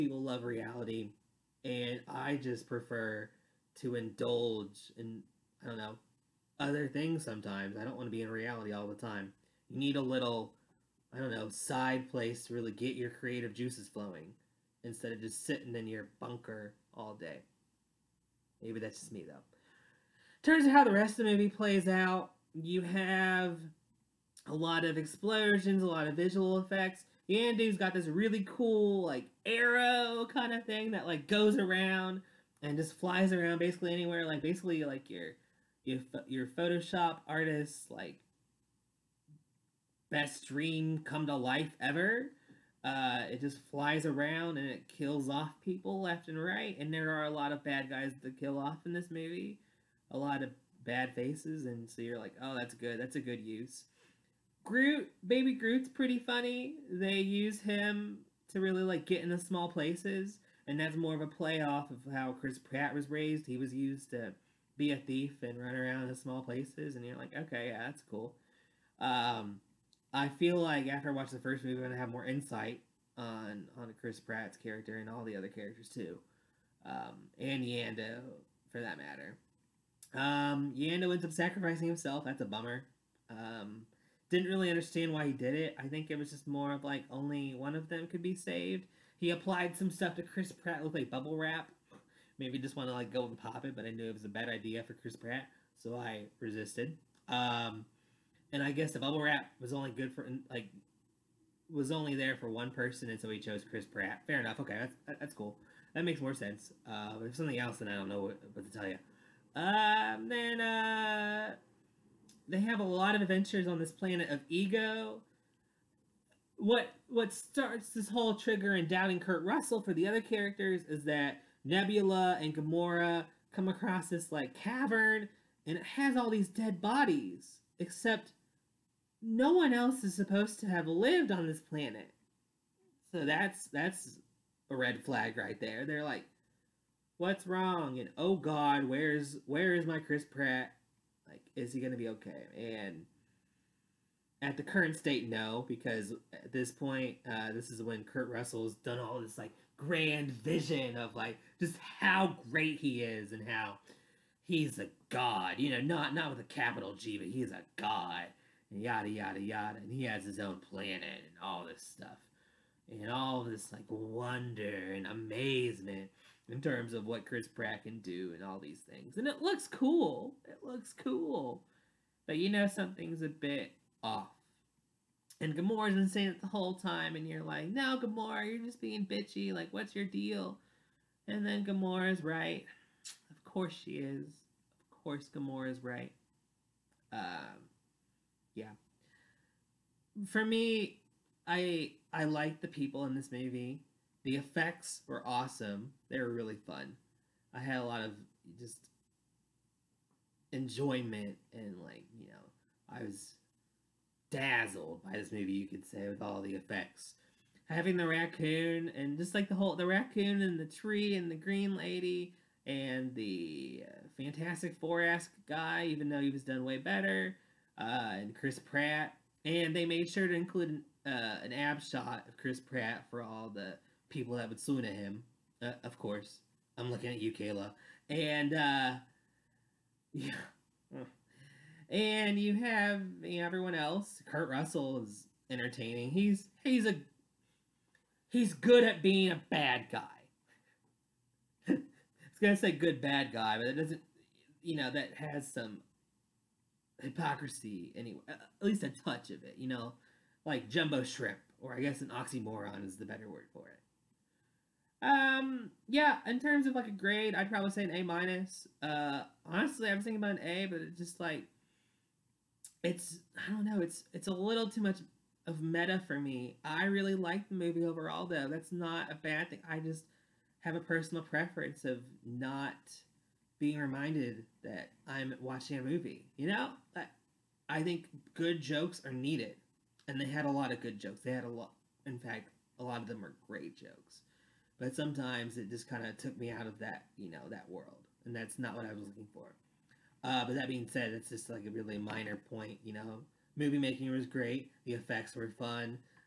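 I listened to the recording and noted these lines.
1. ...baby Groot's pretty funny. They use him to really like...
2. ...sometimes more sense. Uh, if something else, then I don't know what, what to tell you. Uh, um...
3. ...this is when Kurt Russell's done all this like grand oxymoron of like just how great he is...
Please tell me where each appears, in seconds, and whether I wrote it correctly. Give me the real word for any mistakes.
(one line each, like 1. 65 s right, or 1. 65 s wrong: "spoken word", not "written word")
1. 55 s right
2. 106 s wrong: "makes", not "sometimes"
3. 147 s wrong: "vision", not "oxymoron".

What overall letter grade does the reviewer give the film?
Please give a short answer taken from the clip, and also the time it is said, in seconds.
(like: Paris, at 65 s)
A minus, at 257 s.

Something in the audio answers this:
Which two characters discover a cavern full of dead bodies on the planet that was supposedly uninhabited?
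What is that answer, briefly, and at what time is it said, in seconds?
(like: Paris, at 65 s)
Nebula and Gamora, at 121 s.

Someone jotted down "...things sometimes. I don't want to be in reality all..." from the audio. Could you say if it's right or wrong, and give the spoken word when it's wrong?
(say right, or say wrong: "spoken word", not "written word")
right.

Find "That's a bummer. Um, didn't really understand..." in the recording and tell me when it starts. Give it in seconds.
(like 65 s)
82 s.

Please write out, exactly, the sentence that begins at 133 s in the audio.
So that's that's a red flag right there.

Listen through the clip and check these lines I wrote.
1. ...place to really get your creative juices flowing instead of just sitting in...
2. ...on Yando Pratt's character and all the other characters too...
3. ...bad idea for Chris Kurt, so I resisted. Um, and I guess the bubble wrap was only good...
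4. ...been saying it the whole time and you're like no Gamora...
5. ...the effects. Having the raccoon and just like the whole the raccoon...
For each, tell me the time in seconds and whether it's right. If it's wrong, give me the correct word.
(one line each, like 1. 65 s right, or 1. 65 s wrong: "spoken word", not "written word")
1. 12 s right
2. 73 s wrong: "Chris", not "Yando"
3. 94 s wrong: "Pratt", not "Kurt"
4. 175 s right
5. 206 s right.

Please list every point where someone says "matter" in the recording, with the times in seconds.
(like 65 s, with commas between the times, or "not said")
78 s.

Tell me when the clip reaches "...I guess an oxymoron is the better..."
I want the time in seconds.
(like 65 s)
251 s.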